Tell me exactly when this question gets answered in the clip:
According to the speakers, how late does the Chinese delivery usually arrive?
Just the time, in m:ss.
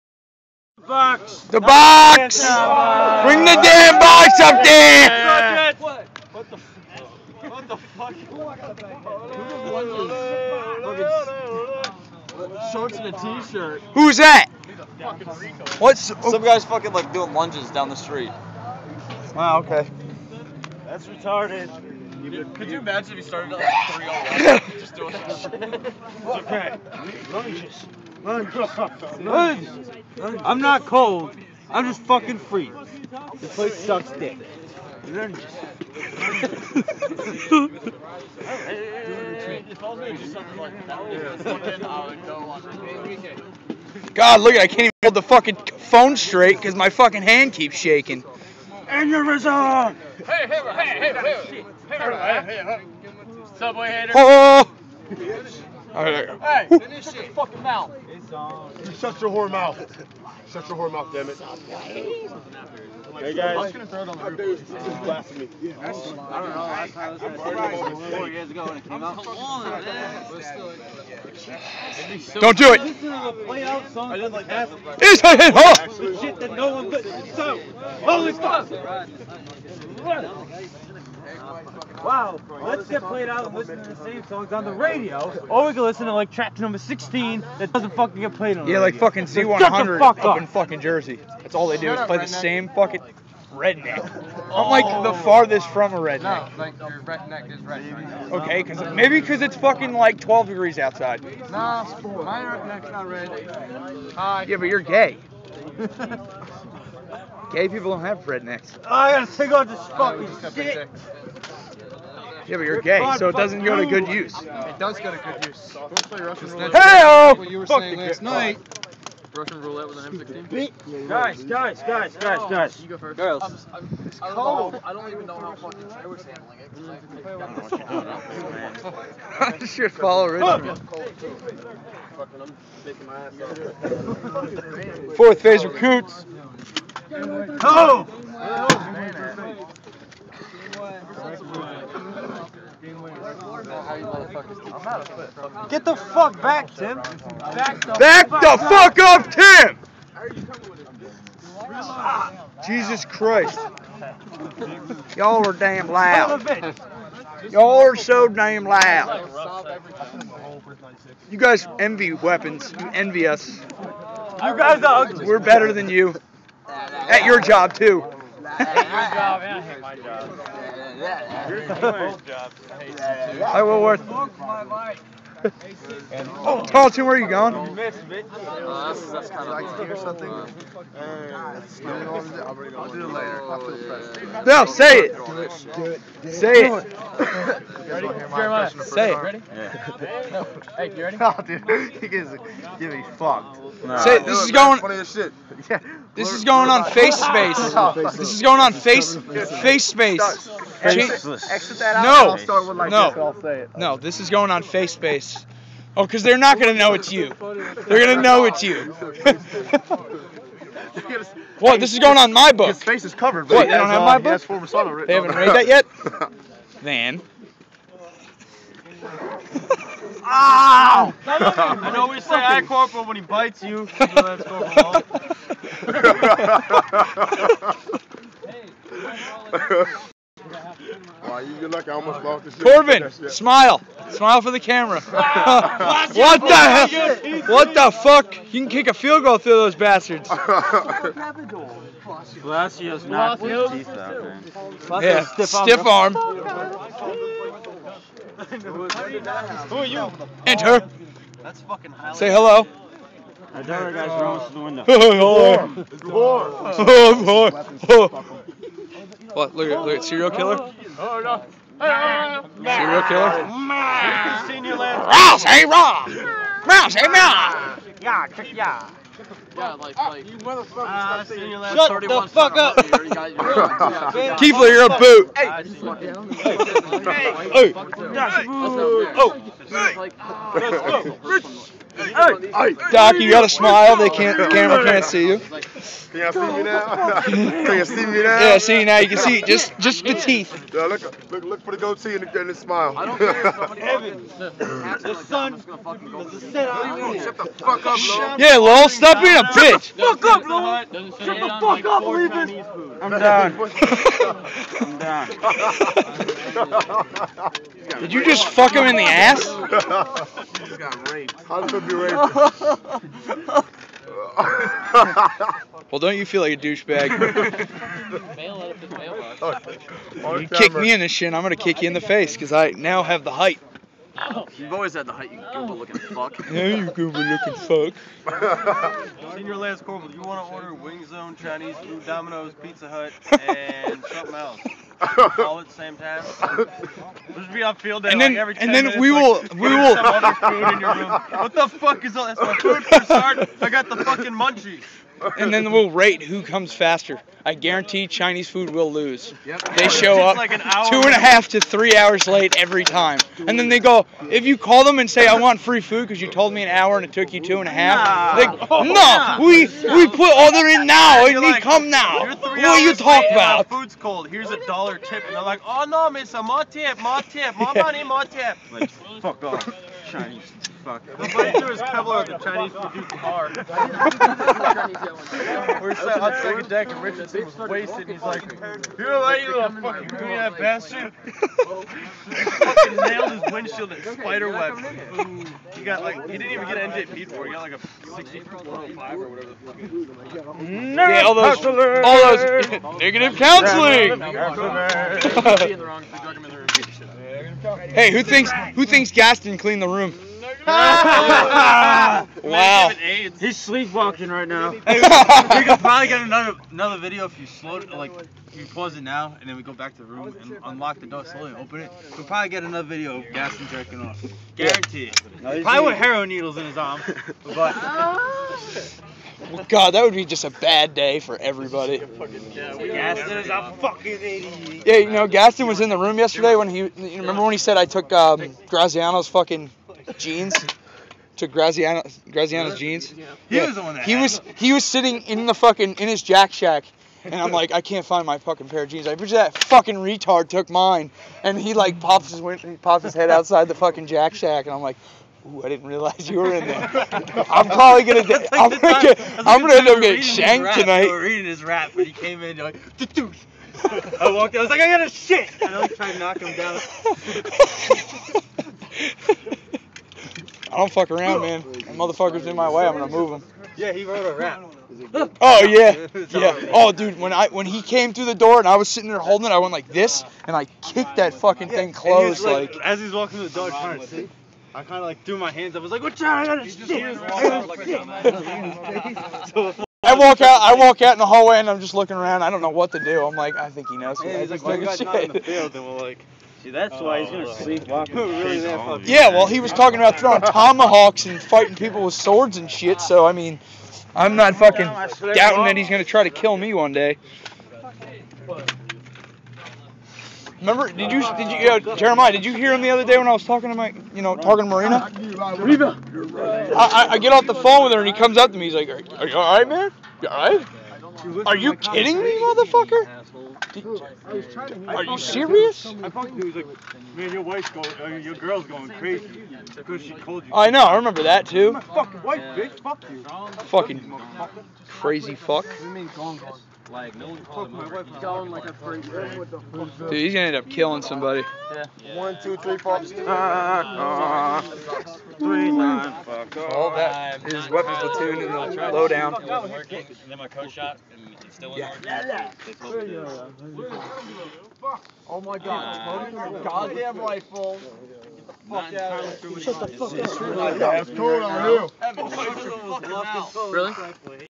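5:50.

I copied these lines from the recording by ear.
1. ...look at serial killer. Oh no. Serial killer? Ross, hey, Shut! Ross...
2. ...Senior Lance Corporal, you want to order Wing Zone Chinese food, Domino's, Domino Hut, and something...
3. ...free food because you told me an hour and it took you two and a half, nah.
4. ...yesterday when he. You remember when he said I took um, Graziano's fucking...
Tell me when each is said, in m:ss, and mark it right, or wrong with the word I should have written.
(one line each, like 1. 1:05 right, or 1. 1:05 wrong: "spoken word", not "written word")
1. 4:19 wrong: "Ross", not "Shut"
2. 5:29 wrong: "Pizza", not "Domino"
3. 5:55 right
4. 7:06 right.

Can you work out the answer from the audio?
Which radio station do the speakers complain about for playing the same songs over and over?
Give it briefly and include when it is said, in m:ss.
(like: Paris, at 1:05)
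Z100, at 1:29.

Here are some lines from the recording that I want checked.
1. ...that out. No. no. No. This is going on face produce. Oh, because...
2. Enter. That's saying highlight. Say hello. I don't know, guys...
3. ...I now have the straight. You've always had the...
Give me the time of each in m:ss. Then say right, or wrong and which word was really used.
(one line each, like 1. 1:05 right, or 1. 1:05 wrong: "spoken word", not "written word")
1. 3:21 wrong: "space", not "produce"
2. 4:10 wrong: "fucking", not "saying"
3. 5:22 wrong: "height", not "straight".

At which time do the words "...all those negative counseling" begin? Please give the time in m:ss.
6:31.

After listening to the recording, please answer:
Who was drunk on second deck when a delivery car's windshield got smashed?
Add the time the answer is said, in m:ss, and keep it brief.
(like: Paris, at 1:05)
Richardson, at 6:17.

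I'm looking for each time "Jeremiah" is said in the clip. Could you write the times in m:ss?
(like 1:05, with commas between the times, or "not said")
3:07, 8:21.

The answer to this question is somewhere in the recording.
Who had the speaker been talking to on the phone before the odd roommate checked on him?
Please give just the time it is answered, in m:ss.
8:24.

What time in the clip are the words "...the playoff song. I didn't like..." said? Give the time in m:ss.
1:13.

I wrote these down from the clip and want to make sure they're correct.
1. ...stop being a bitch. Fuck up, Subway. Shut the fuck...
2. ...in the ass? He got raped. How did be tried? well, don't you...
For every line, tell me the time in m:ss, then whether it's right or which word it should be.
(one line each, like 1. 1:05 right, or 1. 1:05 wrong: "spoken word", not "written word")
1. 4:58 wrong: "Lowell", not "Subway"
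2. 5:08 wrong: "raped", not "tried".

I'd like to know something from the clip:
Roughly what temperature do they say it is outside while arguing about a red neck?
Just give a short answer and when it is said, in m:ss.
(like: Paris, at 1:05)
12 degrees, at 1:40.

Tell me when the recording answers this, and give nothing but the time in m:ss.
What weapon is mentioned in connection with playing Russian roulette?
2:00.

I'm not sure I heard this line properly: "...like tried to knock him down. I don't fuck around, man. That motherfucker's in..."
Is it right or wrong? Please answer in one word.
right.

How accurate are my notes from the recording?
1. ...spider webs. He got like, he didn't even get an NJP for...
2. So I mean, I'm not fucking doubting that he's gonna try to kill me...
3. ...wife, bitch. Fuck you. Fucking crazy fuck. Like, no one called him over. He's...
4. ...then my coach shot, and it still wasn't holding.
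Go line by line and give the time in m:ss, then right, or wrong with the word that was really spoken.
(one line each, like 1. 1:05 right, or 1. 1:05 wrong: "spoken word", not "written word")
1. 6:24 right
2. 8:13 right
3. 8:42 right
4. 9:00 wrong: "working", not "holding".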